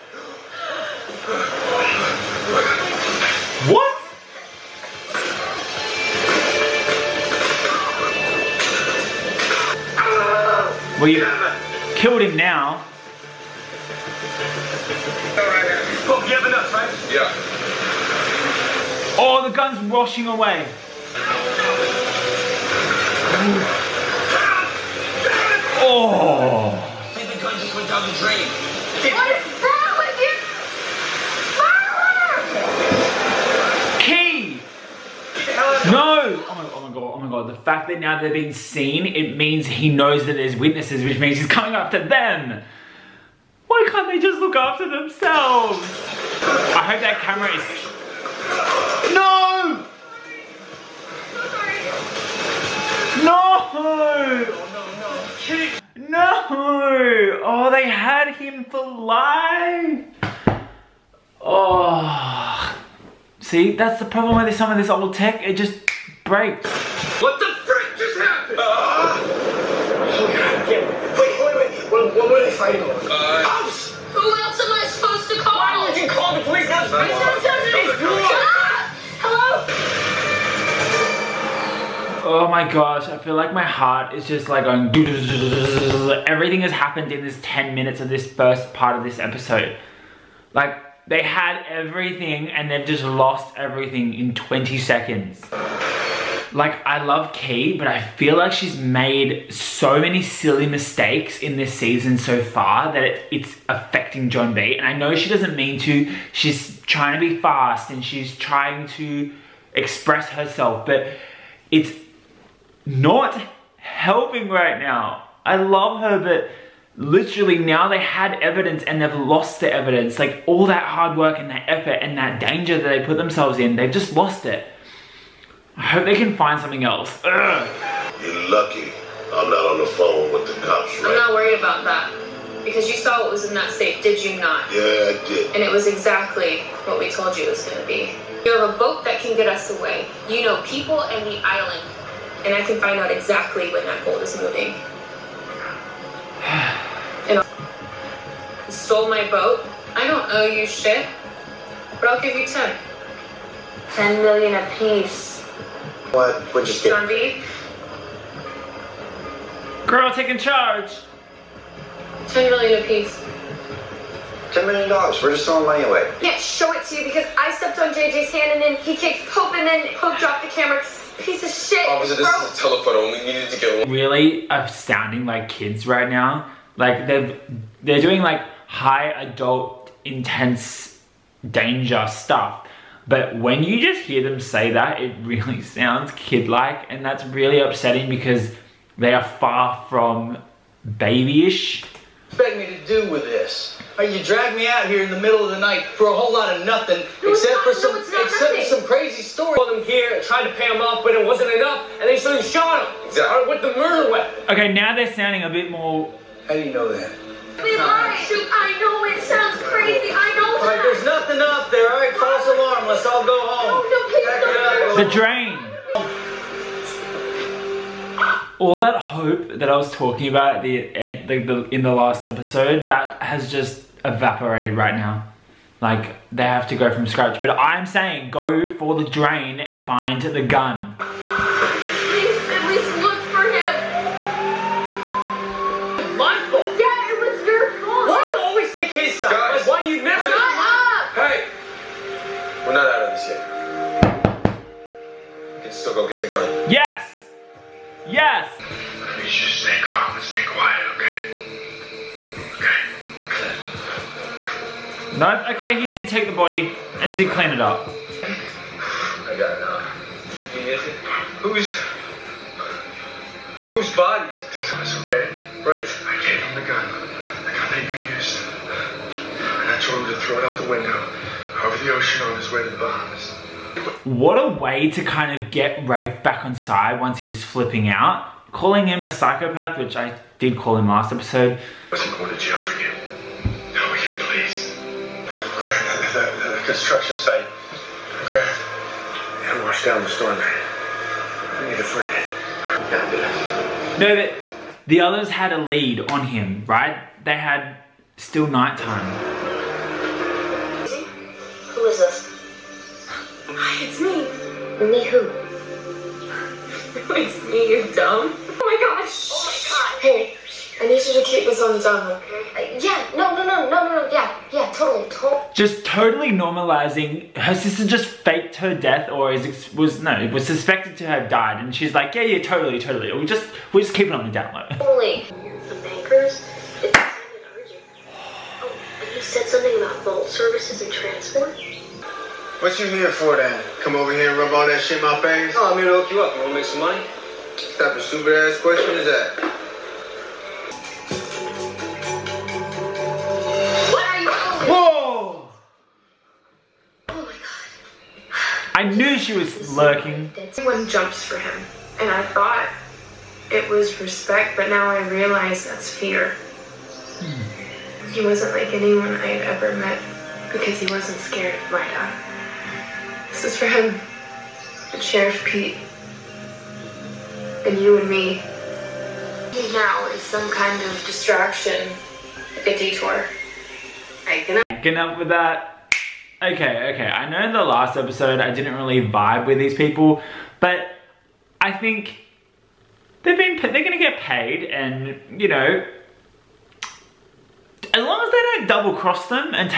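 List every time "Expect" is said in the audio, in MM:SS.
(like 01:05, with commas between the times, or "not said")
03:12.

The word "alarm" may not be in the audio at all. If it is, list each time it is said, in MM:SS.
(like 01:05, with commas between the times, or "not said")
03:32.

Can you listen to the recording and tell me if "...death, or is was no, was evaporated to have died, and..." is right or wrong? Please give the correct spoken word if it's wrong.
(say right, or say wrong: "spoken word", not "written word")
wrong: "suspected", not "evaporated".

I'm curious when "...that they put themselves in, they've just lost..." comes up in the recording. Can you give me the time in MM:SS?
02:02.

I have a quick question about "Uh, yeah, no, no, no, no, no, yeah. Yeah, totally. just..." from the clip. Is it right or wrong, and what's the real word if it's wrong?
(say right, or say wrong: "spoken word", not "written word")
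right.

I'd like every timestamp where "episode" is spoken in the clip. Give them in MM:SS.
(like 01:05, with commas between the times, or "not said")
01:29, 03:42, 04:41, 06:17.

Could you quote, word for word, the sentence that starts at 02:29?
I don't owe you shit, but I'll give you ten.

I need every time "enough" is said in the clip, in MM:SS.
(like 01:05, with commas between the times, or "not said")
03:21, 04:19.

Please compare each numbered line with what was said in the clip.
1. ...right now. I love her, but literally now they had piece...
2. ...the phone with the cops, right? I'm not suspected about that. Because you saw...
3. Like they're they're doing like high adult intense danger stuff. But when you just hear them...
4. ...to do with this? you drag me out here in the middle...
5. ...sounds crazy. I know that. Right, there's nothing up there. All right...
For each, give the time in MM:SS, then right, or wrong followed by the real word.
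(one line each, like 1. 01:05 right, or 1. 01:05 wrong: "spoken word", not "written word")
1. 01:54 wrong: "evidence", not "piece"
2. 02:09 wrong: "worried", not "suspected"
3. 02:56 right
4. 03:12 right
5. 03:29 right.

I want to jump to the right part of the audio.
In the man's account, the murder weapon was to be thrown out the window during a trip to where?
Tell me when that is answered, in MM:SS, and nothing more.
04:32.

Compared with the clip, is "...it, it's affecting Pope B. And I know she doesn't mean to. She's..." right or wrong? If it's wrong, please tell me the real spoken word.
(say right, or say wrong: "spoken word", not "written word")
wrong: "John", not "Pope".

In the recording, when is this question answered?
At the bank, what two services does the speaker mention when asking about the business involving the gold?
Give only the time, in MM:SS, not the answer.
05:30.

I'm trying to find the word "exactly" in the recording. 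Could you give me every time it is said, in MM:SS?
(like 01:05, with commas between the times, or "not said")
02:15, 02:23, 03:23.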